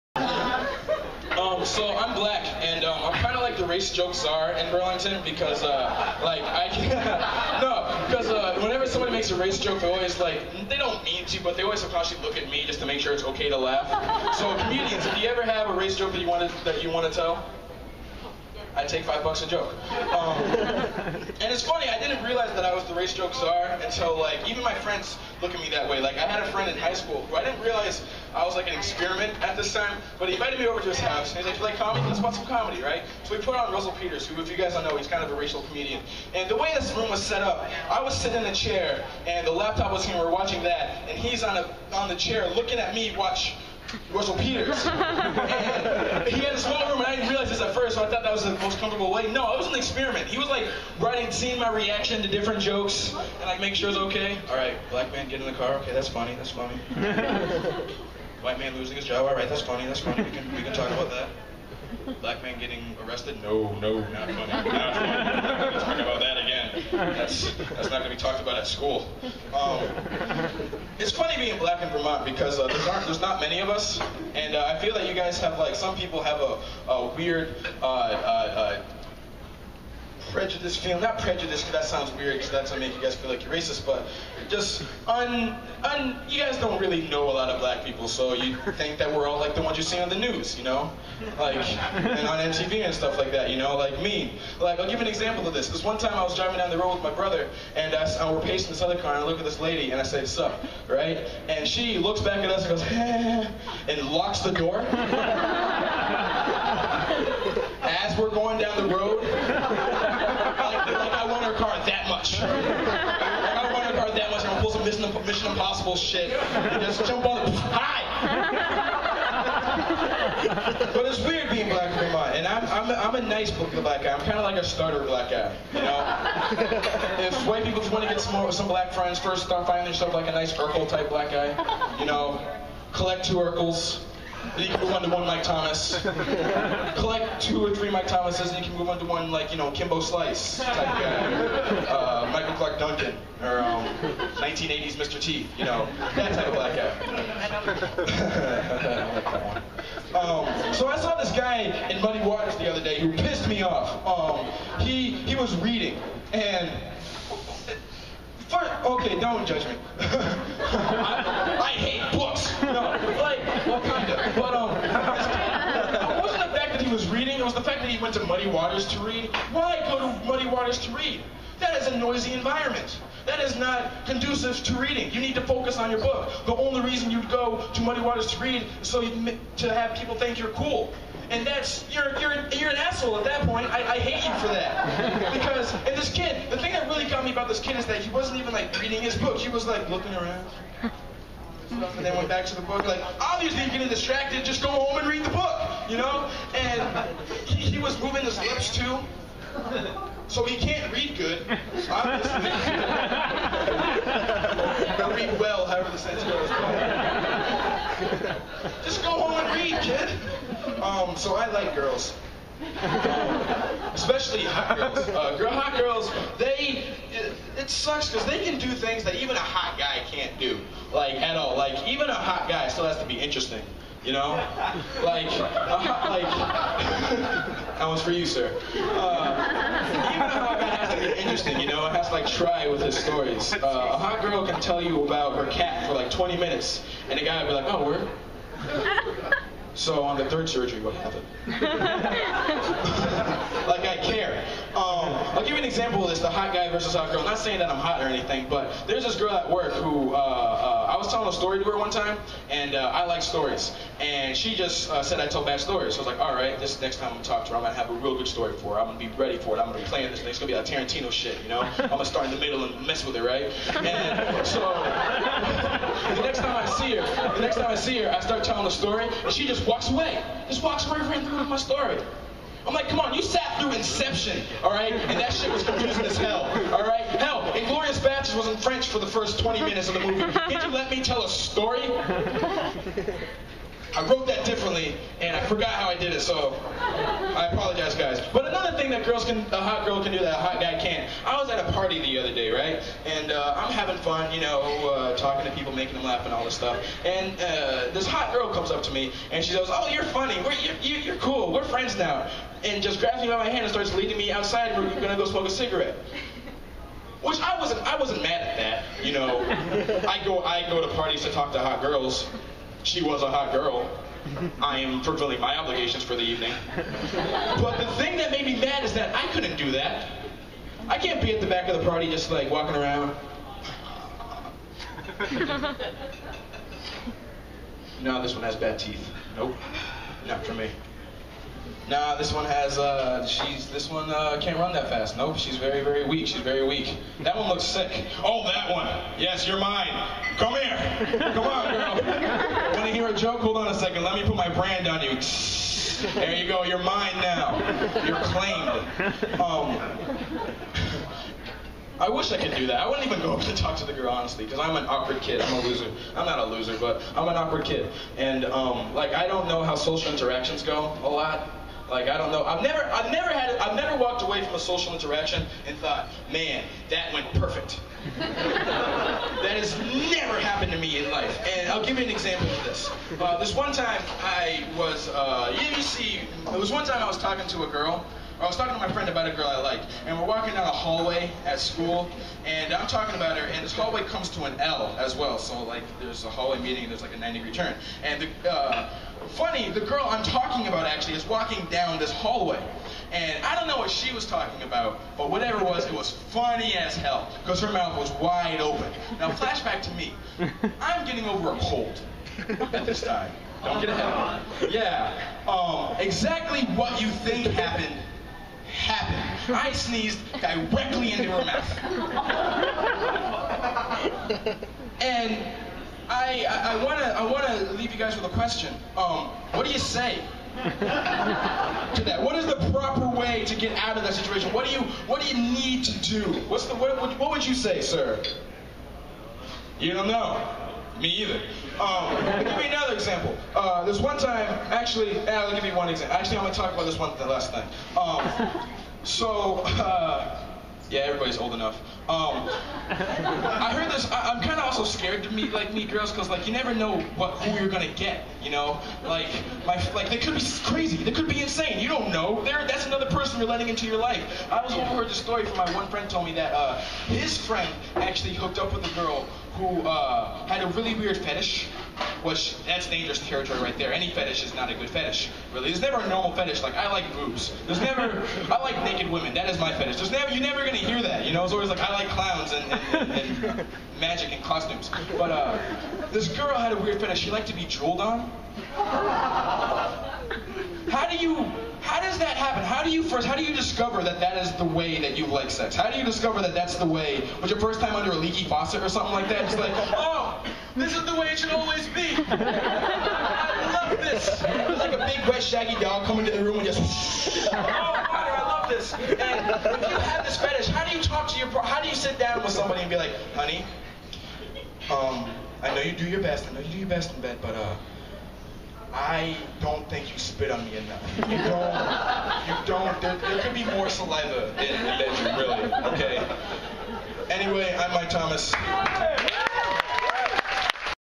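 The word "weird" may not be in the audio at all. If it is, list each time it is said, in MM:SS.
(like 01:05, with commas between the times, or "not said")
01:17, 01:22, 02:01, 07:40, 07:56.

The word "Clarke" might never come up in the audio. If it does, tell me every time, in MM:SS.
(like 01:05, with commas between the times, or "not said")
02:22.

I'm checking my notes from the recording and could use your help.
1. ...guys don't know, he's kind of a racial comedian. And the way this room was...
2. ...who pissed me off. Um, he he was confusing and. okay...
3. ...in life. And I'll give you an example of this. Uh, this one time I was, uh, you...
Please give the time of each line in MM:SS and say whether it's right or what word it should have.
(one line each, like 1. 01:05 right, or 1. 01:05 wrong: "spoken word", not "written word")
1. 00:34 right
2. 02:32 wrong: "reading", not "confusing"
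3. 06:11 right.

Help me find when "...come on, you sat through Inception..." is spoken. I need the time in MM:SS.
04:32.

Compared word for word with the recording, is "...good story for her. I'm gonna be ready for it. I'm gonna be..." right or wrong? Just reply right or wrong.
right.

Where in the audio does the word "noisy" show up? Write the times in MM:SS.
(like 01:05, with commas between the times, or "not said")
02:51.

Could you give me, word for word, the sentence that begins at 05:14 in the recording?
I am fulfilling my obligations for the evening.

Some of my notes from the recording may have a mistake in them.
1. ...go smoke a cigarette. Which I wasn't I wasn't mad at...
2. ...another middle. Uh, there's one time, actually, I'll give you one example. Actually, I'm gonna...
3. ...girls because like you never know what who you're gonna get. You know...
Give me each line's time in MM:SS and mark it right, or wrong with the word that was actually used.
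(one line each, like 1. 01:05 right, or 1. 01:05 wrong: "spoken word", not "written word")
1. 05:05 right
2. 07:12 wrong: "example", not "middle"
3. 07:25 right.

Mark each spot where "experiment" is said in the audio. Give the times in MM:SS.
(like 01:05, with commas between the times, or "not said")
00:28, 00:49.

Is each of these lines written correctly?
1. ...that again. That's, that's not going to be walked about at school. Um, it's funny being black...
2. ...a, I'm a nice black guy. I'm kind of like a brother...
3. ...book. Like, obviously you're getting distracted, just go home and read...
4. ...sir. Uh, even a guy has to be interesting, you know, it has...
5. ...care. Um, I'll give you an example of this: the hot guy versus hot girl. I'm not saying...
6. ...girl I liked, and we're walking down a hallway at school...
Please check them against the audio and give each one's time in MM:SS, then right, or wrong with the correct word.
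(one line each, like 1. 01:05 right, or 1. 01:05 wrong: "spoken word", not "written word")
1. 01:06 wrong: "talked", not "walked"
2. 02:02 wrong: "starter", not "brother"
3. 03:12 right
4. 03:48 right
5. 04:04 right
6. 06:19 right.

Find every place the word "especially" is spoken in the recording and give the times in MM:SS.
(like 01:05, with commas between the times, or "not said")
03:33.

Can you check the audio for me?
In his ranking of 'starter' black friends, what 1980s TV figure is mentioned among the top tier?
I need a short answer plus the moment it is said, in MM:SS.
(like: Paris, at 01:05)
Mr. T, at 02:24.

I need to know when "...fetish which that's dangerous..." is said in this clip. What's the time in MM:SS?
07:41.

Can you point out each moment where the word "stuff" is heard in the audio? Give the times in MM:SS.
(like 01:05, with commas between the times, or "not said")
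01:32, 04:56.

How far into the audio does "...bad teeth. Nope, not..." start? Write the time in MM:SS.
05:28.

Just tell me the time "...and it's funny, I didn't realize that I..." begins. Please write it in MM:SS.
00:20.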